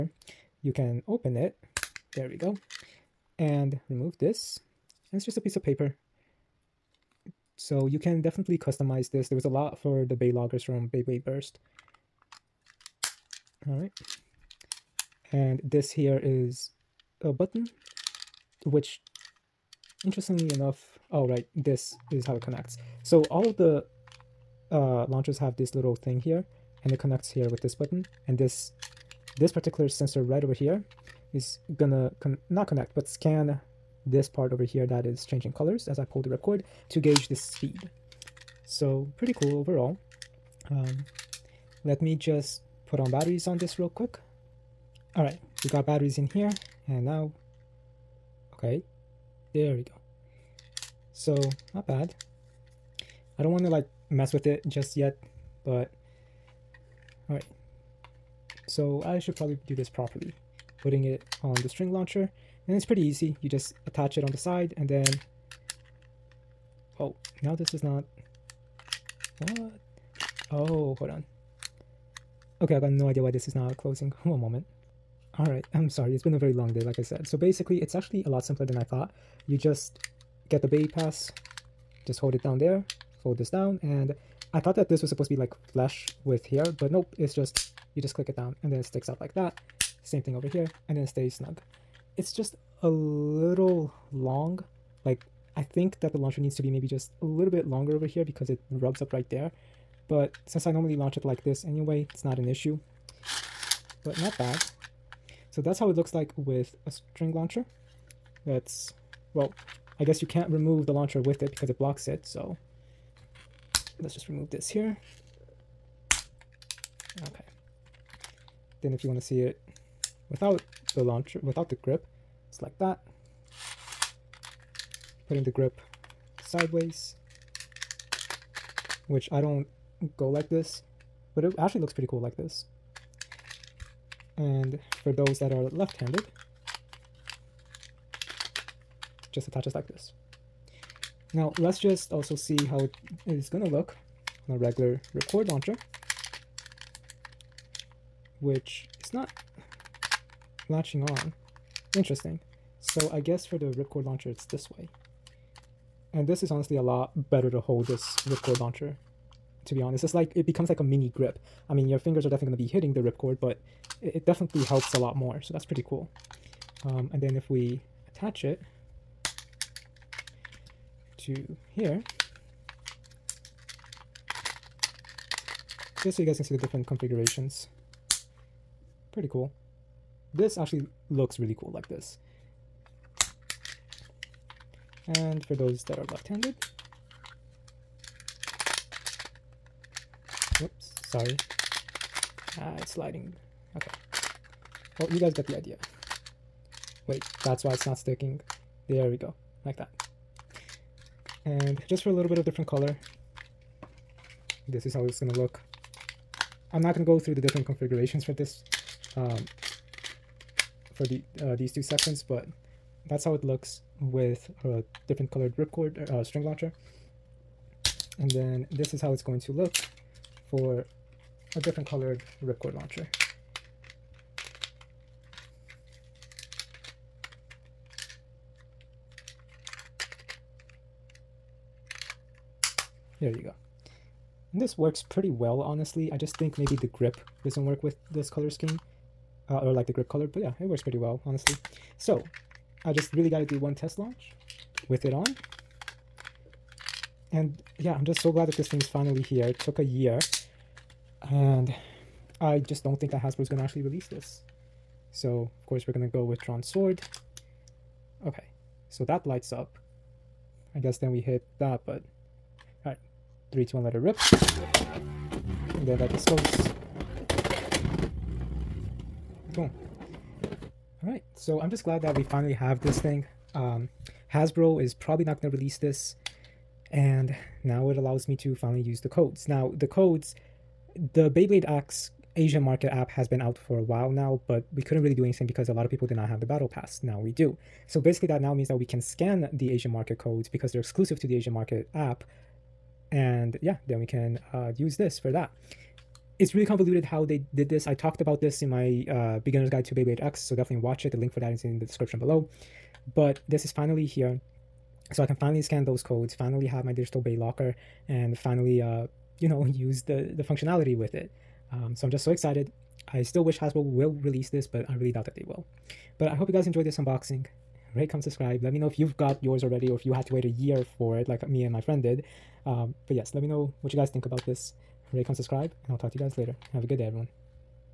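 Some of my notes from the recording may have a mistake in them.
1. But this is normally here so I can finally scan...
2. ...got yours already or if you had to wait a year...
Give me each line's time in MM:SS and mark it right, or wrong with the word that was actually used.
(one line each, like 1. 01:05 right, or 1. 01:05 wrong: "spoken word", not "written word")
1. 05:03 wrong: "finally", not "normally"
2. 05:19 right.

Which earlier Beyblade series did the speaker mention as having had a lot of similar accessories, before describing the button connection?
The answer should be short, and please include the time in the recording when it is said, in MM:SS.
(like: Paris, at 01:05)
Beyblade Burst, at 00:10.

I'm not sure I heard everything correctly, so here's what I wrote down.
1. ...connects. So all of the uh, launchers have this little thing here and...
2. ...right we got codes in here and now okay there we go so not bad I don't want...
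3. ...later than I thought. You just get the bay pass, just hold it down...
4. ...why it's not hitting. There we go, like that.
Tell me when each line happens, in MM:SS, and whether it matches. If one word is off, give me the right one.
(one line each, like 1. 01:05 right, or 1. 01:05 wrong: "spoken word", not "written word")
1. 00:22 right
2. 00:45 wrong: "batteries", not "codes"
3. 01:18 wrong: "simpler", not "later"
4. 03:17 wrong: "sticking", not "hitting".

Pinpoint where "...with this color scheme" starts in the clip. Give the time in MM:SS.
03:57.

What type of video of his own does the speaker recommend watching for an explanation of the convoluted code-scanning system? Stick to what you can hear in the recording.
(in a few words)
Beginner's guide to Beyblade X.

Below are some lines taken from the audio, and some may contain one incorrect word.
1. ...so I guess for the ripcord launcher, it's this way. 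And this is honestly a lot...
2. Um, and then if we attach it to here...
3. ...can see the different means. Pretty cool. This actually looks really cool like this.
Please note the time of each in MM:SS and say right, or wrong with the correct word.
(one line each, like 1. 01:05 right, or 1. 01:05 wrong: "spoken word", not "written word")
1. 02:32 right
2. 02:46 right
3. 02:56 wrong: "configurations", not "means".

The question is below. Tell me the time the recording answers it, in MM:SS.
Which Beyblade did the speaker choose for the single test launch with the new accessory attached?
04:16.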